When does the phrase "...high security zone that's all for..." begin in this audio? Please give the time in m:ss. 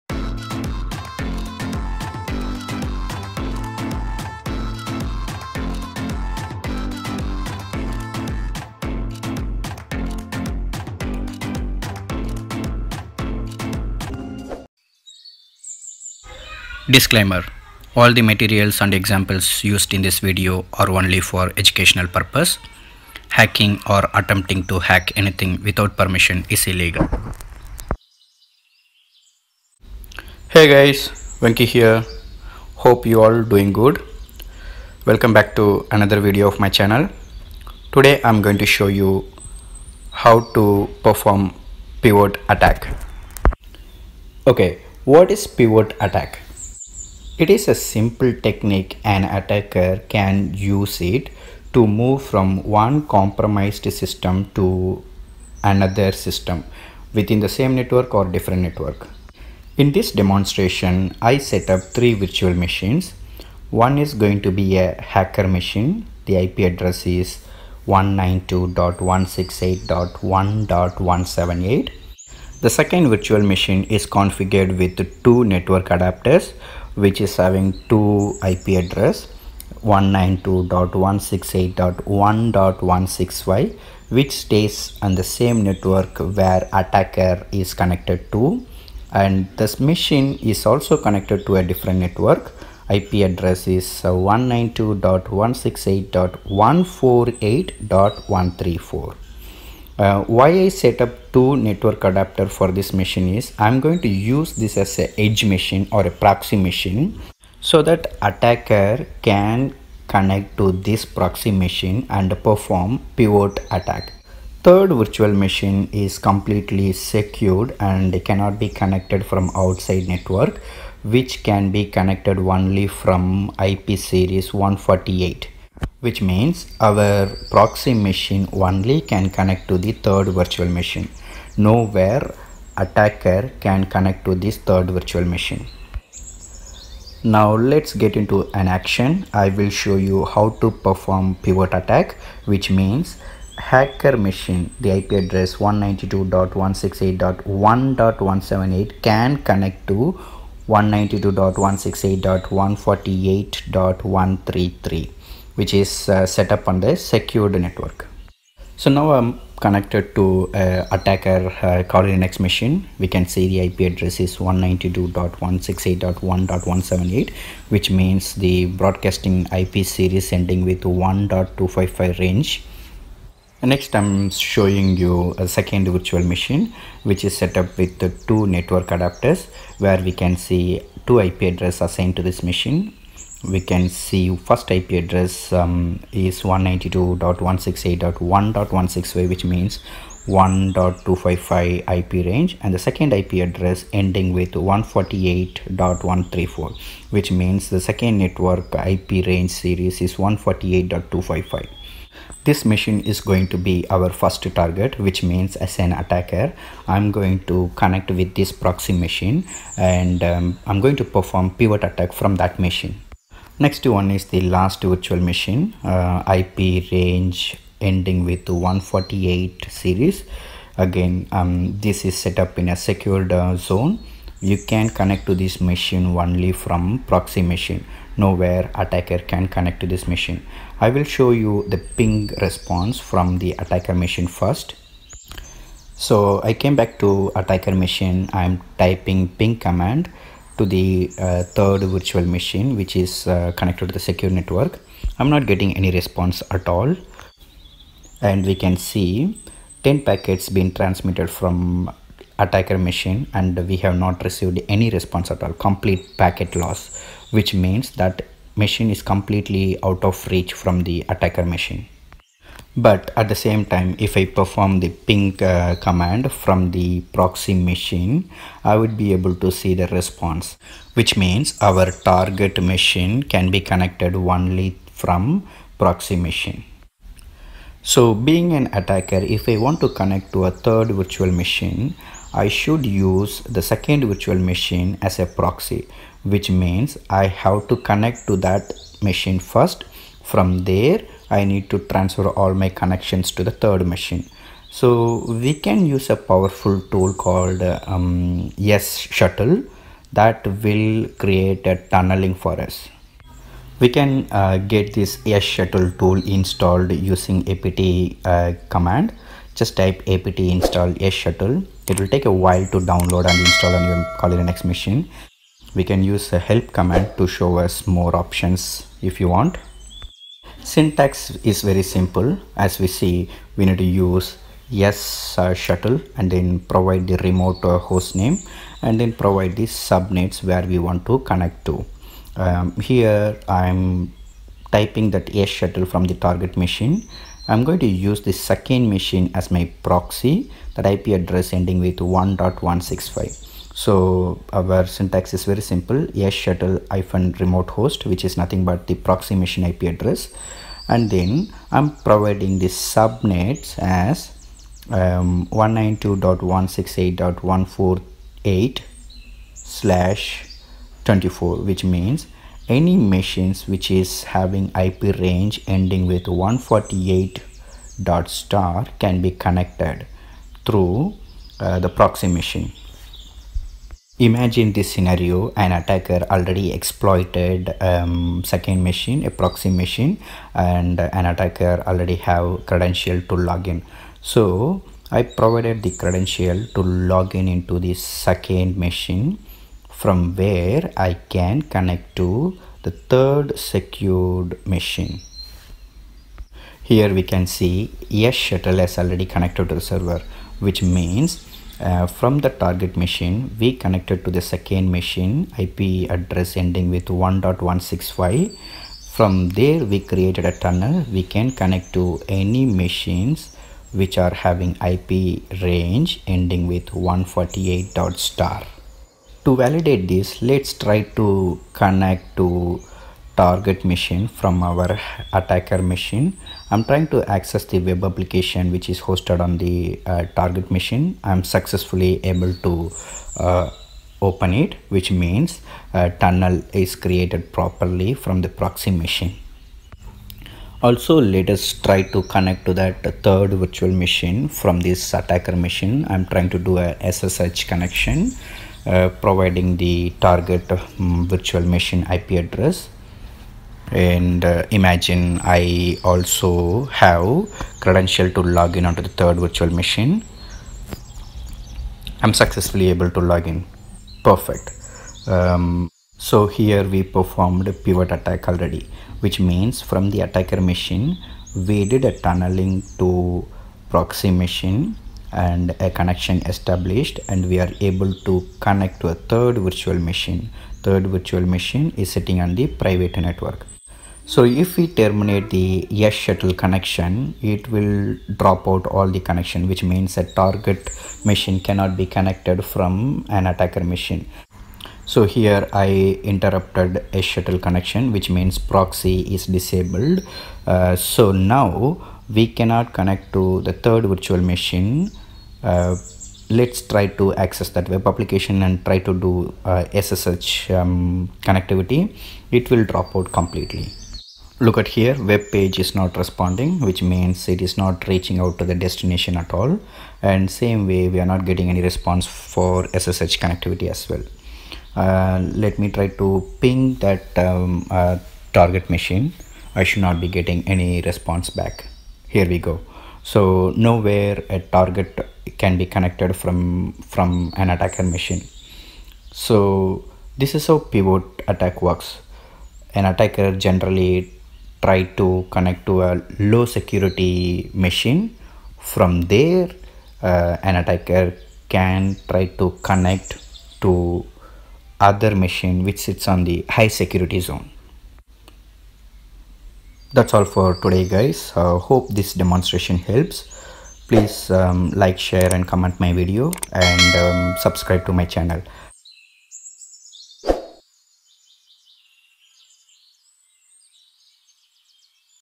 9:16.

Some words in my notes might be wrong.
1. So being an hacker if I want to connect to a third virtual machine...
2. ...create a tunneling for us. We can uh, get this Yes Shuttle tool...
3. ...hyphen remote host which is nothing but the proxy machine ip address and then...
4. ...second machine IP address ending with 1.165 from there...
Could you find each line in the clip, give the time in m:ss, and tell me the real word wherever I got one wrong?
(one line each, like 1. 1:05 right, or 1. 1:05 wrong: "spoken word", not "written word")
1. 4:37 wrong: "attacker", not "hacker"
2. 5:01 right
3. 5:46 right
4. 6:44 right.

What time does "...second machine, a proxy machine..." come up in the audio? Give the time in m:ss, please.
6:18.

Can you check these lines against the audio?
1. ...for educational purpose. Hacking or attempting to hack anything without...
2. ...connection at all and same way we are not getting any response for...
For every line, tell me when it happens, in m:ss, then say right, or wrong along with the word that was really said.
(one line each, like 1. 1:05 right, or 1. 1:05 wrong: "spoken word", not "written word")
1. 0:21 right
2. 8:38 wrong: "destination", not "connection".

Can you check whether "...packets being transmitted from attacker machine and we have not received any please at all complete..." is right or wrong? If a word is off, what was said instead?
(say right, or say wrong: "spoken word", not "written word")
wrong: "response", not "please".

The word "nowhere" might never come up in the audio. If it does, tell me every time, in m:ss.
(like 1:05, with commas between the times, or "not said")
2:11, 3:48, 8:53.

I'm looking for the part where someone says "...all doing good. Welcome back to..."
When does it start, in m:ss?
0:33.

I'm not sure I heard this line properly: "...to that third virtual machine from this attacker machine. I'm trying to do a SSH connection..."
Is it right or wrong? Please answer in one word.
right.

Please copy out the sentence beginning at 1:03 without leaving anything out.
One is going to be a hacker machine.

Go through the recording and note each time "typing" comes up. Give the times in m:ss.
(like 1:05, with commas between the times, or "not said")
3:58, 5:34.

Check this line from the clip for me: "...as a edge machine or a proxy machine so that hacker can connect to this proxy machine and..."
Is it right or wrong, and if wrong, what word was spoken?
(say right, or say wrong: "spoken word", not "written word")
wrong: "attacker", not "hacker".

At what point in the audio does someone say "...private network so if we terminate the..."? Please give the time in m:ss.
8:02.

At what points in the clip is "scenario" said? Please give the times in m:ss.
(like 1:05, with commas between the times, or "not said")
6:14.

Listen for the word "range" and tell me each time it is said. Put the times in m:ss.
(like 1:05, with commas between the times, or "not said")
2:52, 3:12, 3:19, 3:36, 6:05, 6:55.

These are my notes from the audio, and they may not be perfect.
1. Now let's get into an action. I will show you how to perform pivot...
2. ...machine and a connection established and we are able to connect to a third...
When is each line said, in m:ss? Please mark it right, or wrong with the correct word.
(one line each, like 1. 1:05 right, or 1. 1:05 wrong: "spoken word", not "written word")
1. 2:17 right
2. 7:54 right.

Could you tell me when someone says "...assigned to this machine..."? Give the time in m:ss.
3:01.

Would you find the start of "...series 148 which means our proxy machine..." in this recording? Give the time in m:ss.
2:03.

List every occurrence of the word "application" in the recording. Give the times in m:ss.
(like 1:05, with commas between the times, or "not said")
7:08, 8:28.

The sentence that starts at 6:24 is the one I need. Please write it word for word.
So I provided the credential to login into the second machine from where I can connect to the third secured machine.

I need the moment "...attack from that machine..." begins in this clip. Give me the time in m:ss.
3:31.